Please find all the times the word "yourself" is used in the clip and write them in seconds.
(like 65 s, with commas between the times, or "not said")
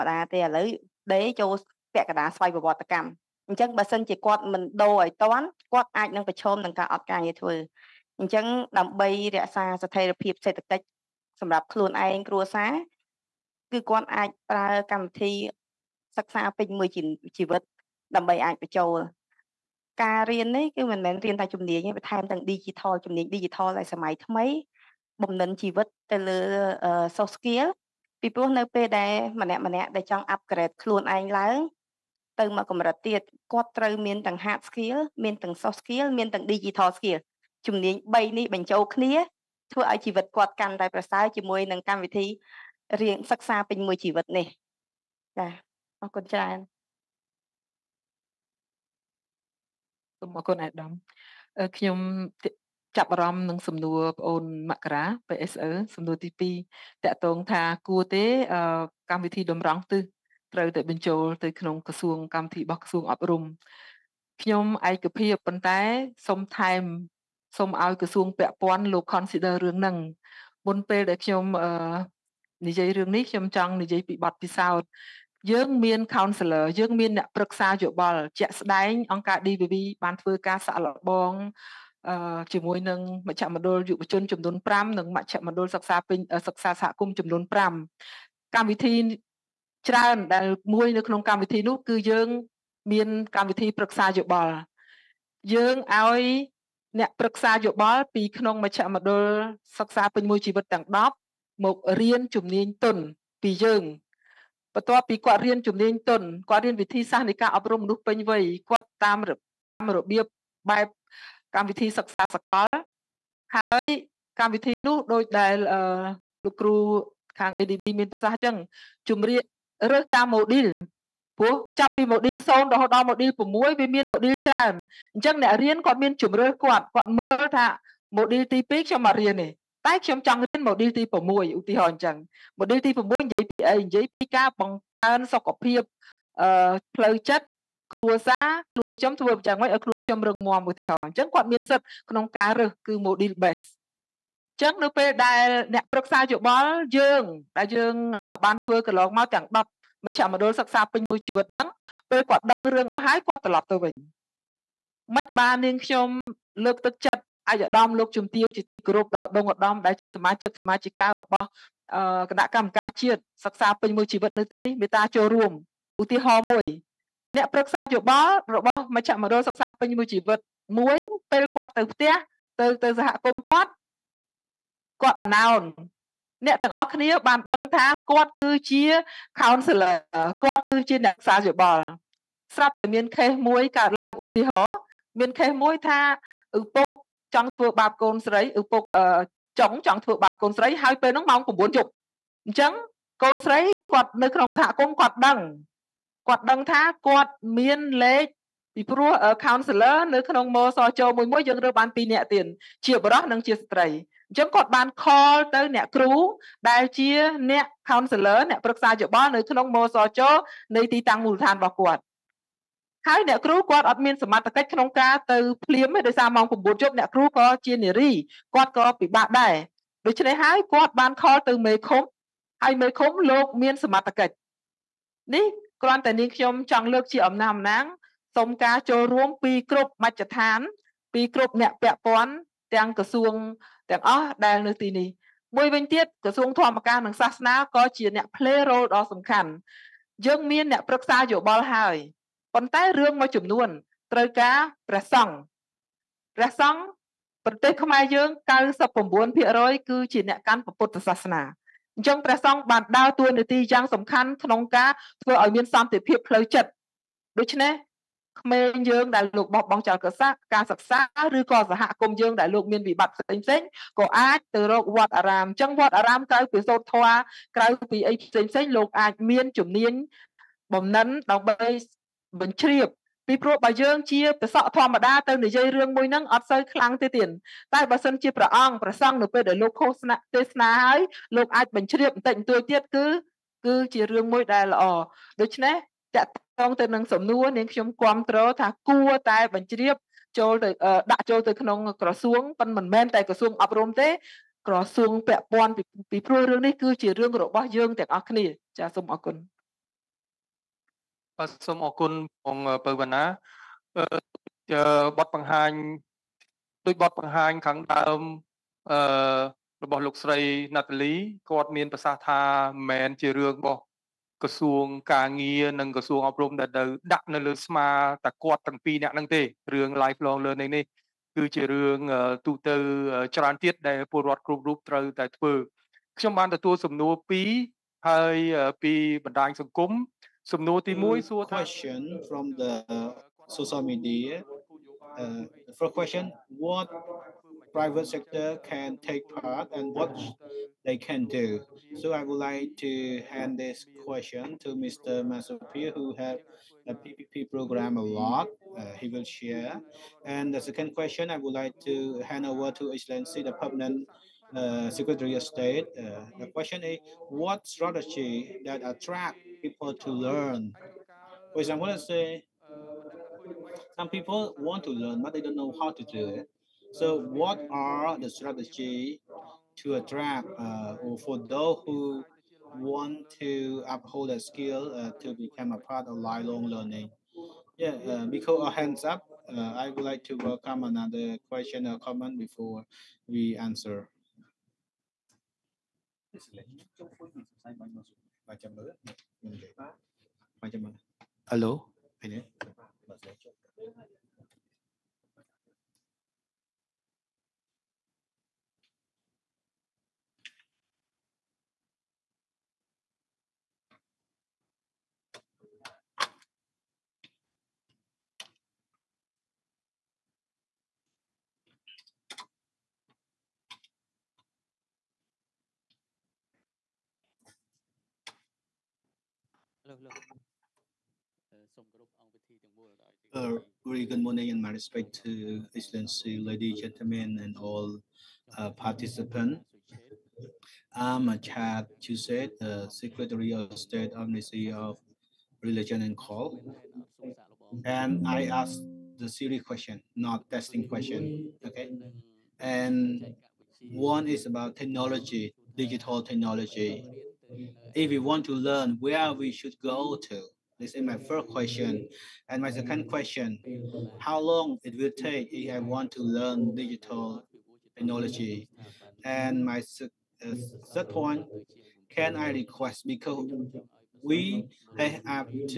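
not said.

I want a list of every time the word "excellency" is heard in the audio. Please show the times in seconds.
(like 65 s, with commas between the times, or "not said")
352 s, 425 s.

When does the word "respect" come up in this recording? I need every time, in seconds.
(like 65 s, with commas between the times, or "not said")
424 s.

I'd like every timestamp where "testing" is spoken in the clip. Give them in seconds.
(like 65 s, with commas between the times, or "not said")
440 s.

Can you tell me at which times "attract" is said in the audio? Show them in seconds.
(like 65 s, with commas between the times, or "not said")
358 s, 369 s.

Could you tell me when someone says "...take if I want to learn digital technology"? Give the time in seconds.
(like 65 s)
455 s.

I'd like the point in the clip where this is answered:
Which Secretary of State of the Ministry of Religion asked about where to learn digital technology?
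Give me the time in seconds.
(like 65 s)
431 s.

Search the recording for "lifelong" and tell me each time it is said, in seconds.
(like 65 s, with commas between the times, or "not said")
320 s, 376 s.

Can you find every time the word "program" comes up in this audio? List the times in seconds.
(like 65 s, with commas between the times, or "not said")
347 s.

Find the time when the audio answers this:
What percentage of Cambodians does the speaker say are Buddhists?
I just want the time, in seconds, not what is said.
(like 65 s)
248 s.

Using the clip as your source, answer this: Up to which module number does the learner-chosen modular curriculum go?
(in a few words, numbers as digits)
6.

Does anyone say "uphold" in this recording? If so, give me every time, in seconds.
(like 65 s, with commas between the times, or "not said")
373 s.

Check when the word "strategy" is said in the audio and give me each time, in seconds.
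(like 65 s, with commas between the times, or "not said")
357 s, 368 s.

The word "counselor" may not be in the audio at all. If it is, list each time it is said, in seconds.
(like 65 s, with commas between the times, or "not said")
76 s, 179 s, 199 s, 207 s.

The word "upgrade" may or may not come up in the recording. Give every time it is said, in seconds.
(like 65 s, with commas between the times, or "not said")
30 s.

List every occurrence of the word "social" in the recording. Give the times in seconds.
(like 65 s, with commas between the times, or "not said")
333 s.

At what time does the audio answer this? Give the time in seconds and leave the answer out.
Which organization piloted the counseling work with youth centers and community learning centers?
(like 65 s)
79 s.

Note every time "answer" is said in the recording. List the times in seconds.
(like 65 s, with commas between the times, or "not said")
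383 s.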